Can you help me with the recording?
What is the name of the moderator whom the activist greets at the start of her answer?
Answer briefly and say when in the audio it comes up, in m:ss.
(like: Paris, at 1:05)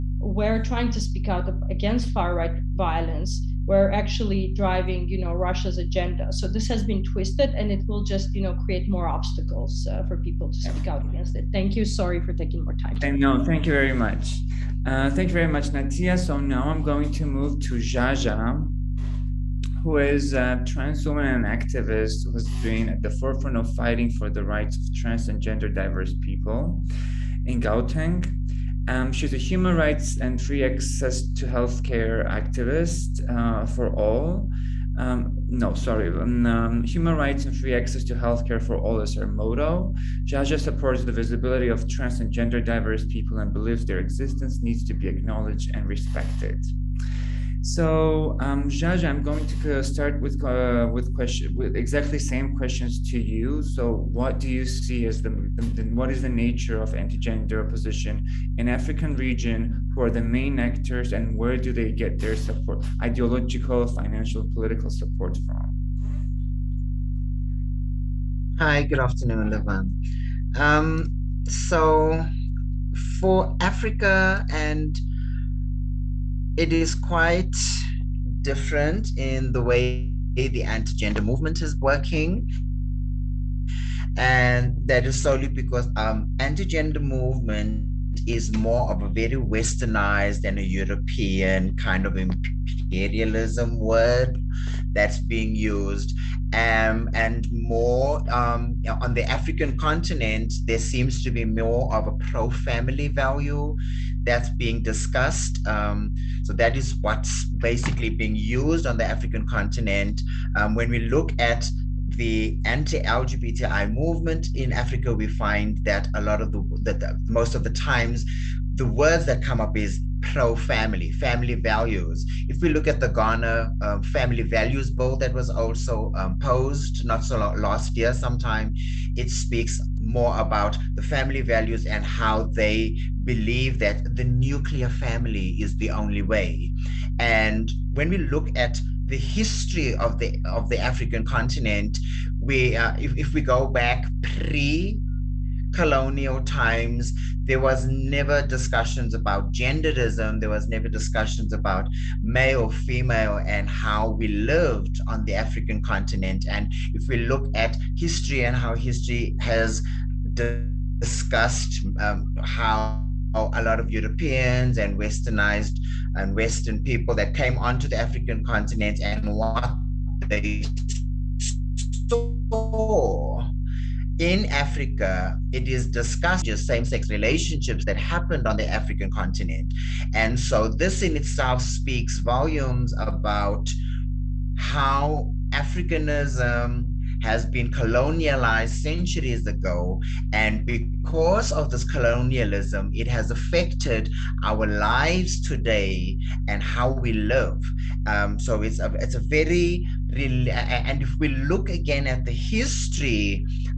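Levan, at 1:09.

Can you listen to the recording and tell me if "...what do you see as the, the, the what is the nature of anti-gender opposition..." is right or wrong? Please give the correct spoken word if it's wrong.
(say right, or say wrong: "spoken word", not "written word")
right.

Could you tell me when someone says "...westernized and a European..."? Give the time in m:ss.
1:29.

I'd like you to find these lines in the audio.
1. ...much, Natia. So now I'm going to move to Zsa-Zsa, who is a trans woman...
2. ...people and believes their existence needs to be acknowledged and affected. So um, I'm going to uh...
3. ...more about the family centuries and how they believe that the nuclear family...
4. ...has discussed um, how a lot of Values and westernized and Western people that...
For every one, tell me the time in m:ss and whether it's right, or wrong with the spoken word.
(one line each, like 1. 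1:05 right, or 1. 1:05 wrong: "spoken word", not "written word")
1. 0:15 right
2. 0:43 wrong: "respected", not "affected"
3. 2:09 wrong: "values", not "centuries"
4. 2:39 wrong: "Europeans", not "Values".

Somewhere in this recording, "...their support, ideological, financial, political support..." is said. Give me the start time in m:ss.
1:02.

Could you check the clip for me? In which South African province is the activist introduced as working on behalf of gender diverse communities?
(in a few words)
Gauteng.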